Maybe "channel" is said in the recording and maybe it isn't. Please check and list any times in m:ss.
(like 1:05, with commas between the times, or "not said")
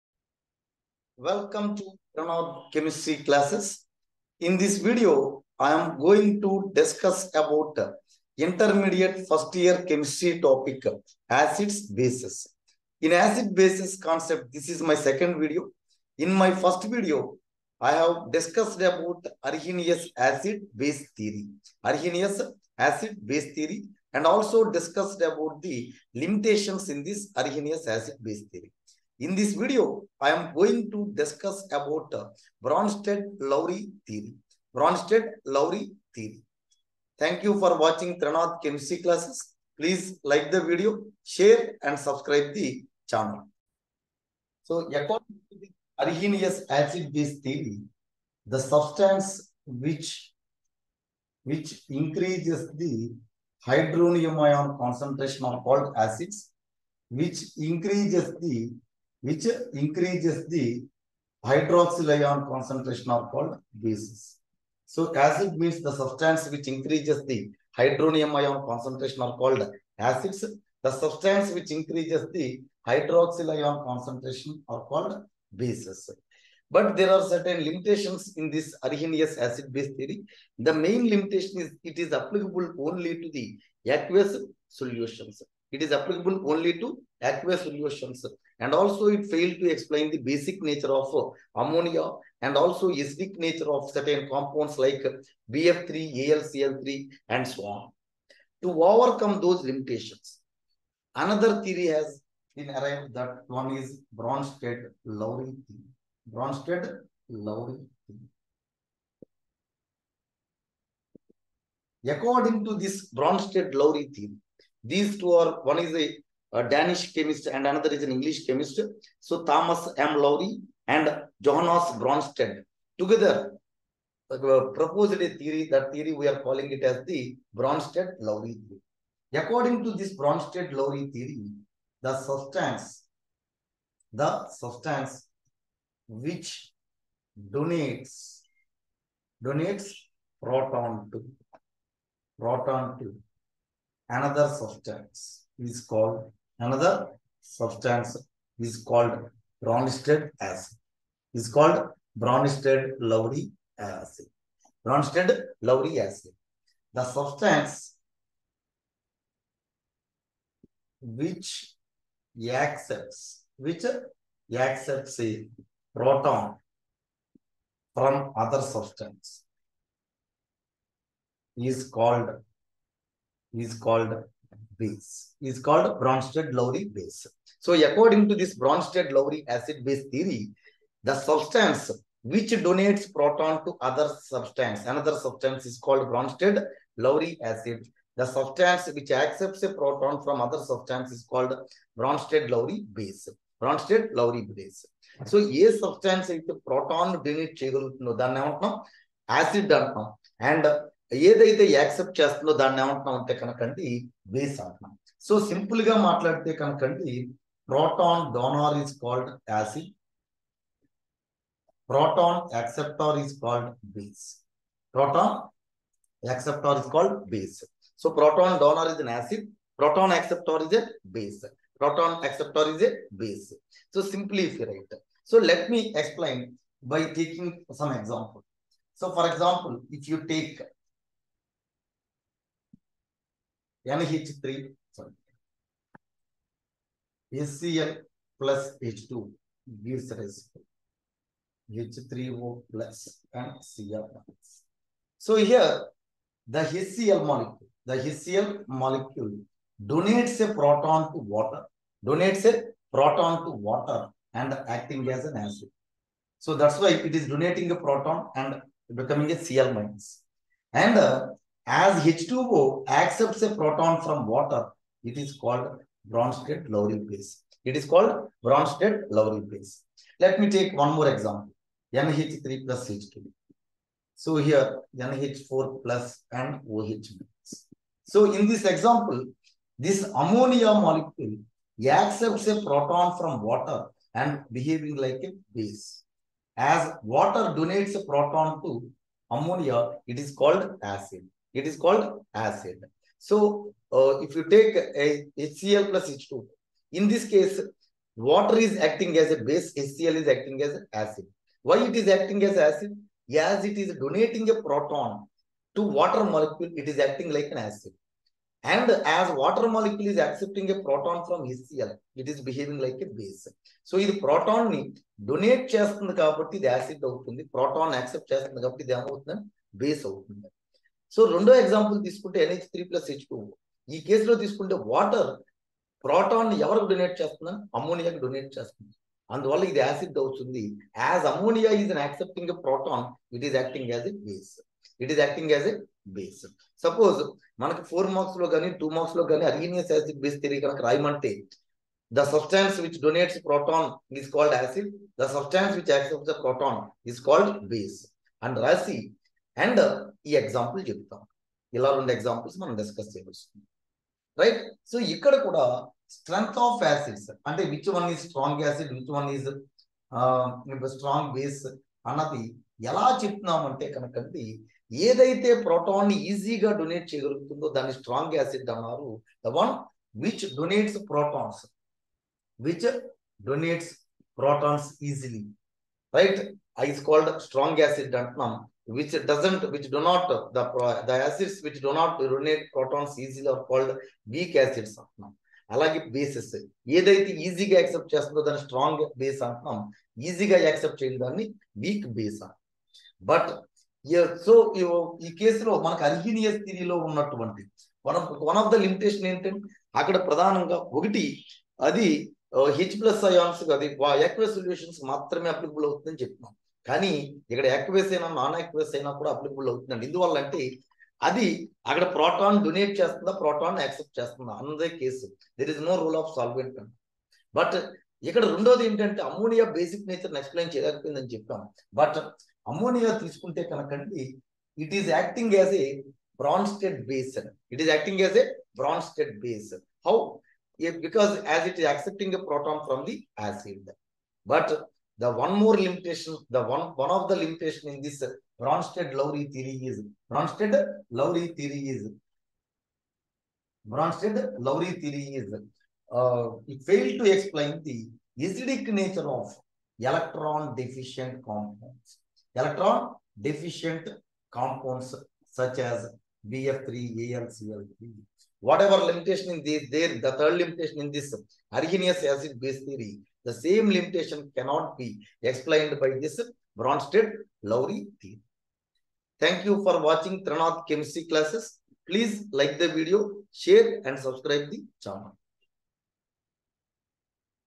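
0:43, 7:55.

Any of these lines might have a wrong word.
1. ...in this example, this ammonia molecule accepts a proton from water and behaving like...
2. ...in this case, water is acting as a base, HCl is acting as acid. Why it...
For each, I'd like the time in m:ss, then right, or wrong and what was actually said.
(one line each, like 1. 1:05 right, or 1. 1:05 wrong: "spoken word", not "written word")
1. 4:38 right
2. 4:56 right.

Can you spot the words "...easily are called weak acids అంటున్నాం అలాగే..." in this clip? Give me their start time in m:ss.
6:23.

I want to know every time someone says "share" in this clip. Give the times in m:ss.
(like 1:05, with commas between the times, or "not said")
0:41, 7:53.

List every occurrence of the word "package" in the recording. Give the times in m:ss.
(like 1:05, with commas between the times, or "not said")
not said.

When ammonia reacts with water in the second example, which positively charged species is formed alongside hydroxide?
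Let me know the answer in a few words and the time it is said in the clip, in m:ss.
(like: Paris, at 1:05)
NH4 plus, at 4:34.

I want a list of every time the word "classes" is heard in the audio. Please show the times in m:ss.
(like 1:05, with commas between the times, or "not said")
0:03, 0:38, 7:51.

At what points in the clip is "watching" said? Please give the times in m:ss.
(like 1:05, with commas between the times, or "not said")
0:37, 7:50.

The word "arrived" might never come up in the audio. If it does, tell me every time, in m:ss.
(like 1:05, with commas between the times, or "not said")
1:42.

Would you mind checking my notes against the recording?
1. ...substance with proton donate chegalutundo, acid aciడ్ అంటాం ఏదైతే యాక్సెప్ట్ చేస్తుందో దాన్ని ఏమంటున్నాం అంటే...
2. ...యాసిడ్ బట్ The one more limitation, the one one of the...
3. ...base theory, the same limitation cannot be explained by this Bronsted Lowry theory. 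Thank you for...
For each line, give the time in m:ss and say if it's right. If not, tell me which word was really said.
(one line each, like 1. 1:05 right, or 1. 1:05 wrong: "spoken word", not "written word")
1. 3:15 right
2. 7:13 right
3. 7:42 right.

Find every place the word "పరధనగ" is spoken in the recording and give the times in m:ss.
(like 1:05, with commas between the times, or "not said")
6:40.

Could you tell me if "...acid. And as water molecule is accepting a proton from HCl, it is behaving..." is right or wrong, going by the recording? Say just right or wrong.
right.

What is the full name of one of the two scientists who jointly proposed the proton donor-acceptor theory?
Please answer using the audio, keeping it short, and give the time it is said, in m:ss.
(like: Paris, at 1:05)
Thomas M. Lowry, at 1:59.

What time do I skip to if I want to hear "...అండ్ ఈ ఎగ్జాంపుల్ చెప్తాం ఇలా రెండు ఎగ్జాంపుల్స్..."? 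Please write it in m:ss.
5:49.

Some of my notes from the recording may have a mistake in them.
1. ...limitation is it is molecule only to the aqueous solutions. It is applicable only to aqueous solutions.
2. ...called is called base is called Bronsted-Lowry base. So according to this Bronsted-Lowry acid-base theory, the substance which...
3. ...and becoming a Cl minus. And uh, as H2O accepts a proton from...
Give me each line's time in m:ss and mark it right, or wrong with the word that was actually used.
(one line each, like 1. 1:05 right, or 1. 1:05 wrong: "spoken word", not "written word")
1. 1:21 wrong: "applicable", not "molecule"
2. 2:51 right
3. 4:18 right.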